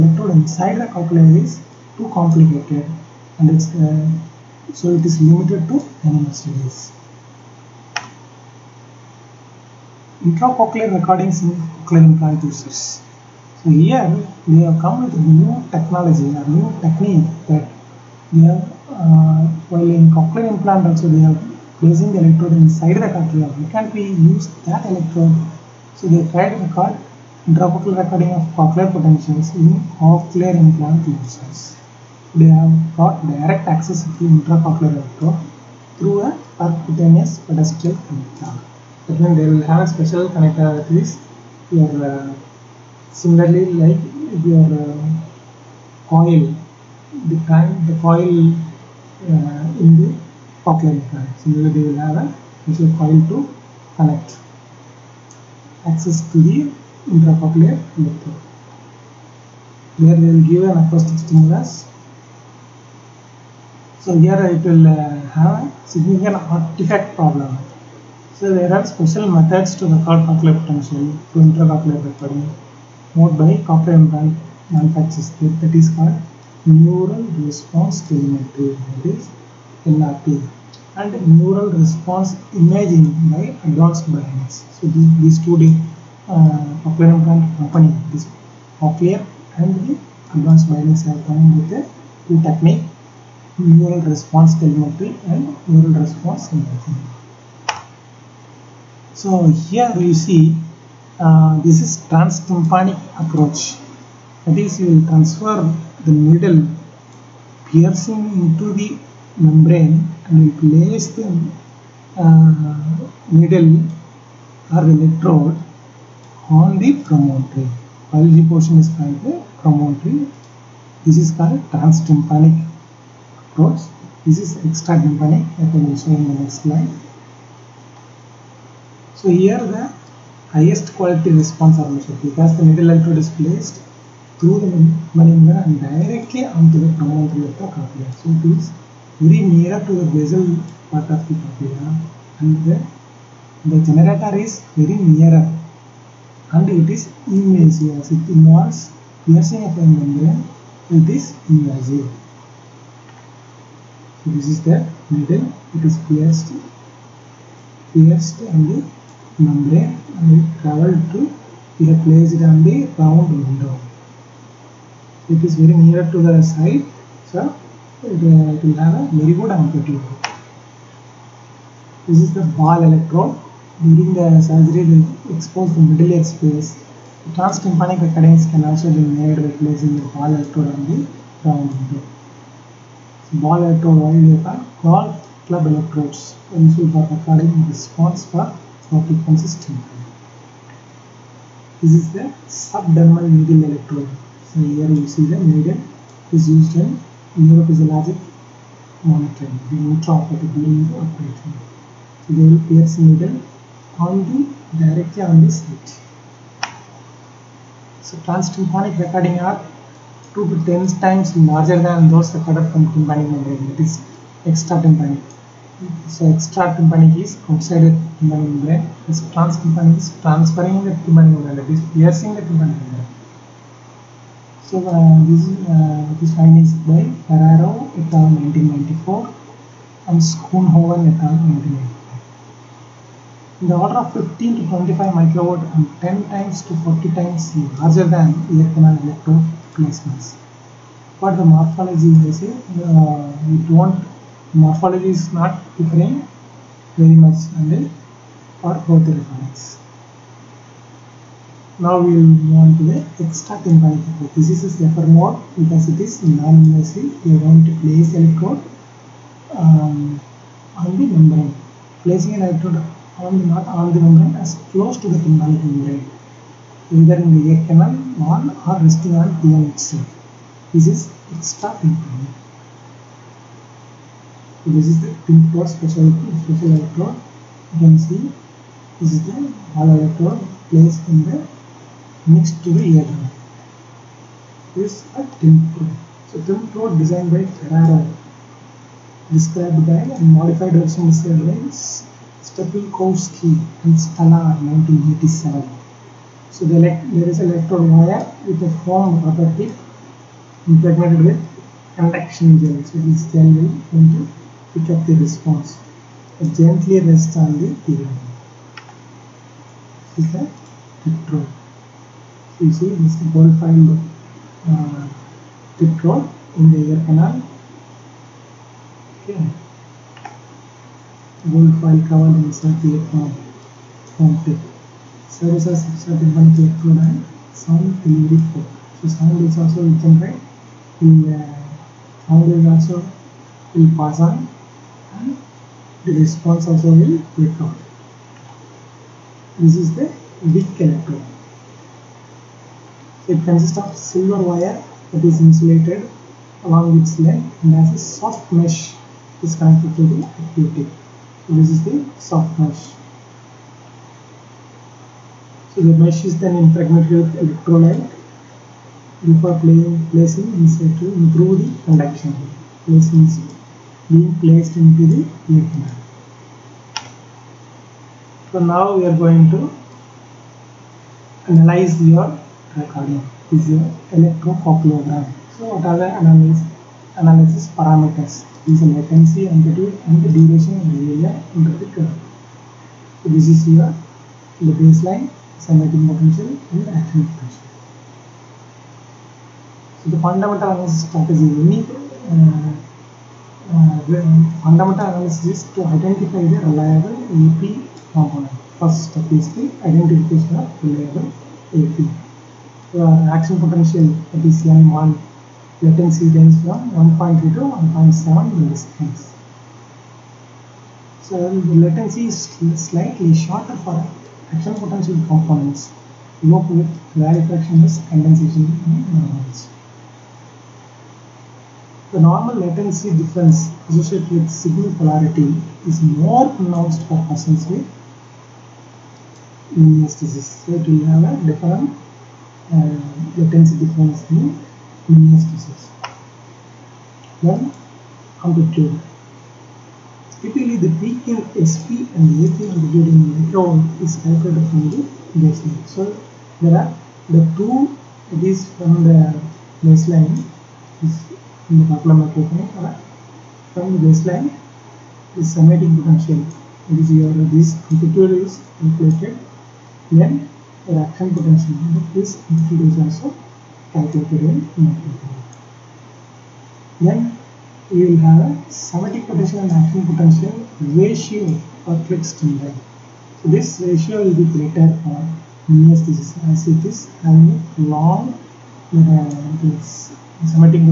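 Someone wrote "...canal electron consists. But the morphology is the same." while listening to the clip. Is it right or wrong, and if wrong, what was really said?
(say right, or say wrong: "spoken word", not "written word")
wrong: "placements", not "consists".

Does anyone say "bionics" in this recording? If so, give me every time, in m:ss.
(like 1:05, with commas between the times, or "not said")
1:24, 1:30.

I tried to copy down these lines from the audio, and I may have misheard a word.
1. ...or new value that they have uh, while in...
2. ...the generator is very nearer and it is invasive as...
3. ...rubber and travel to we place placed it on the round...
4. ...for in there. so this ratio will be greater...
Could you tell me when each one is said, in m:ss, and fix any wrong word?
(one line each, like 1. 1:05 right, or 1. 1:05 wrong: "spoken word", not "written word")
1. 0:16 wrong: "technique", not "value"
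2. 2:23 right
3. 2:39 wrong: "number", not "rubber"
4. 7:51 right.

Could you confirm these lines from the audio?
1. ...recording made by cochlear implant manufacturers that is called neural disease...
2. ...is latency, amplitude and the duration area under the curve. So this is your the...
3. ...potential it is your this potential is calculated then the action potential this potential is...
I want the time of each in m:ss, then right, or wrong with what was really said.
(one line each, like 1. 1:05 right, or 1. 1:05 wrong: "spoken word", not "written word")
1. 1:12 wrong: "response", not "disease"
2. 6:18 right
3. 7:35 right.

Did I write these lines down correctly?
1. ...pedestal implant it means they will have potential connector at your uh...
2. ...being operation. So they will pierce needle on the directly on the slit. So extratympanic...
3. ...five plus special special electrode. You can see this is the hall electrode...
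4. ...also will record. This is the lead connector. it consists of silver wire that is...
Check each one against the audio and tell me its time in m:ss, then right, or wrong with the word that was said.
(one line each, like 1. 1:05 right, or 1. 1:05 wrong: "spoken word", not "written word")
1. 0:37 wrong: "special", not "potential"
2. 3:20 wrong: "transtympanic", not "extratympanic"
3. 4:35 wrong: "two", not "five"
4. 5:36 right.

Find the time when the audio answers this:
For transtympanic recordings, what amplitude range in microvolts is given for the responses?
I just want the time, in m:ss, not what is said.
3:54.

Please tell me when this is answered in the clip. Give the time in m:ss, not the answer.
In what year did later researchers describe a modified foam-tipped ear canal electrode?
4:54.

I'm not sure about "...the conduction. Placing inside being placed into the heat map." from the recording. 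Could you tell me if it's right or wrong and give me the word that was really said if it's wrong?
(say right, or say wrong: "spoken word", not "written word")
right.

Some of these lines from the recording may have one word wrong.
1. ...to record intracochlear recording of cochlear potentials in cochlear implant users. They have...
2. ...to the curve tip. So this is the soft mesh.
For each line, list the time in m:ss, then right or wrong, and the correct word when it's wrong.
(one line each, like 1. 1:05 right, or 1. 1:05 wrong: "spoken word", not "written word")
1. 0:26 right
2. 5:49 wrong: "active", not "curve".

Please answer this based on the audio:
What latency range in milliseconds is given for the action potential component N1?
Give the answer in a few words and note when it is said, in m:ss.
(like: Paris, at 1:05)
1.2 to 1.7 milliseconds, at 6:46.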